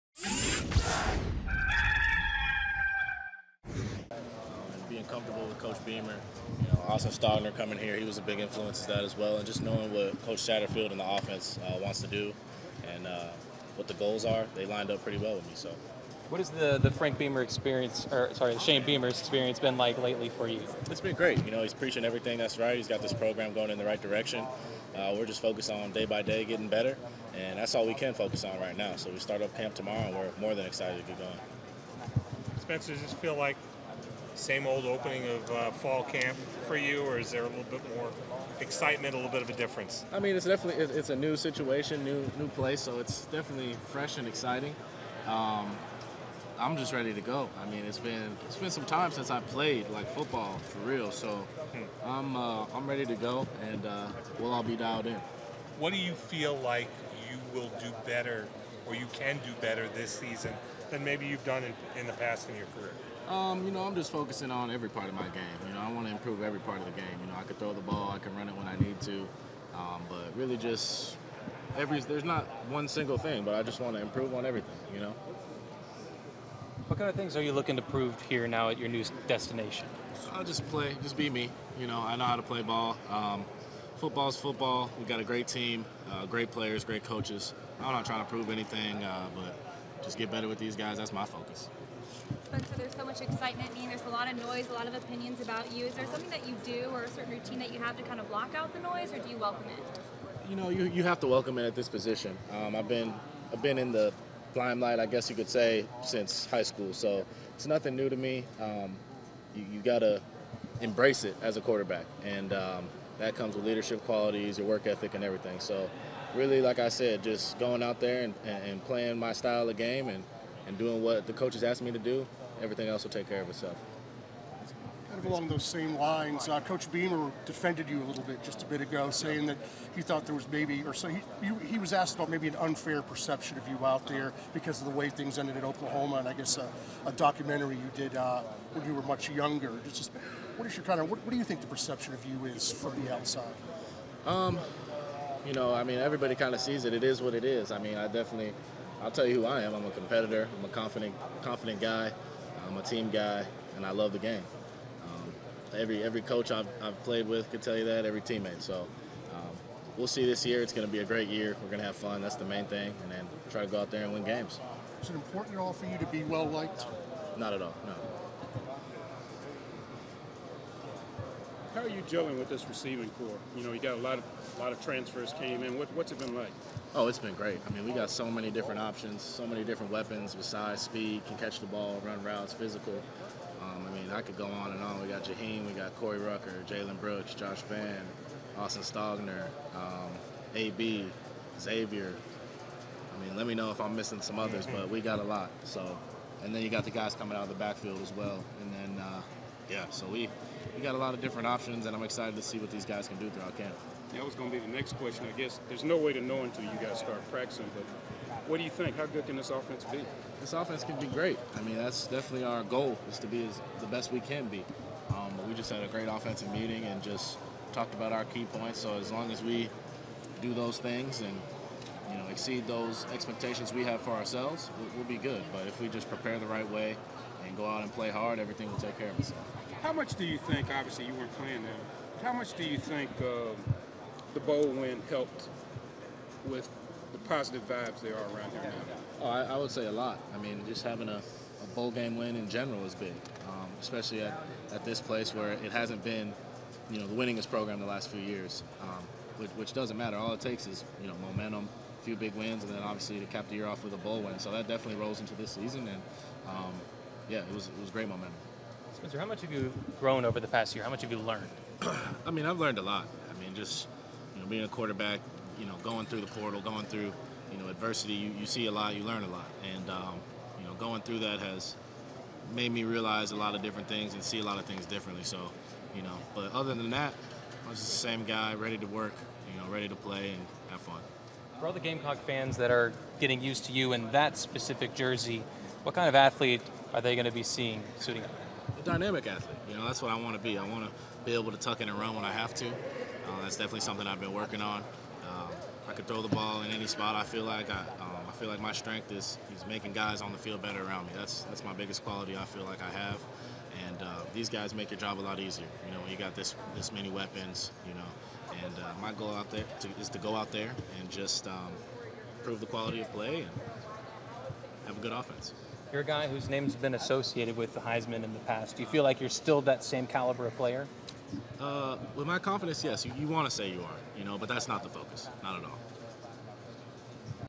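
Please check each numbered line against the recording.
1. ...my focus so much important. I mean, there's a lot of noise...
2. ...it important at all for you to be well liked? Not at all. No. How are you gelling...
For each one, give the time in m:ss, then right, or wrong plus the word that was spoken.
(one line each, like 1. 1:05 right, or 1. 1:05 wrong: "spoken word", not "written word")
1. 1:31 wrong: "excitement", not "important"
2. 2:45 right.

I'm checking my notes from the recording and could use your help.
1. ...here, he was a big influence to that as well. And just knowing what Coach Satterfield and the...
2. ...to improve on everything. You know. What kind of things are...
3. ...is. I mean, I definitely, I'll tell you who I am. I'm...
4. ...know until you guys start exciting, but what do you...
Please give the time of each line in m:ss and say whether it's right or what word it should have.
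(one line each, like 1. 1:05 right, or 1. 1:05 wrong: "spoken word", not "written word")
1. 0:07 right
2. 1:13 right
3. 2:27 right
4. 3:26 wrong: "practicing", not "exciting".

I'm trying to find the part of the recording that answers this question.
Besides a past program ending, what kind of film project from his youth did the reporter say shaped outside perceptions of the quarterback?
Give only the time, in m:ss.
2:17.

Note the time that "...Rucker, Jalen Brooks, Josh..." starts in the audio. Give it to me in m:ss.
3:06.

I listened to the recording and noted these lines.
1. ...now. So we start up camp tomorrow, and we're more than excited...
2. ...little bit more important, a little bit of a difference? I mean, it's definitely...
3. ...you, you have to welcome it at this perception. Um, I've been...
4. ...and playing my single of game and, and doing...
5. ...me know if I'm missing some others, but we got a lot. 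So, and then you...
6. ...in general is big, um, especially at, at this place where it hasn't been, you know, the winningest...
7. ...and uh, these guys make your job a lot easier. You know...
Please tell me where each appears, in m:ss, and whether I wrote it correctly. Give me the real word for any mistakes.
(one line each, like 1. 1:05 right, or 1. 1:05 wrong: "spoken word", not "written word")
1. 0:28 right
2. 0:37 wrong: "excitement", not "important"
3. 1:40 wrong: "position", not "perception"
4. 1:58 wrong: "style", not "single"
5. 3:13 right
6. 4:02 right
7. 5:03 right.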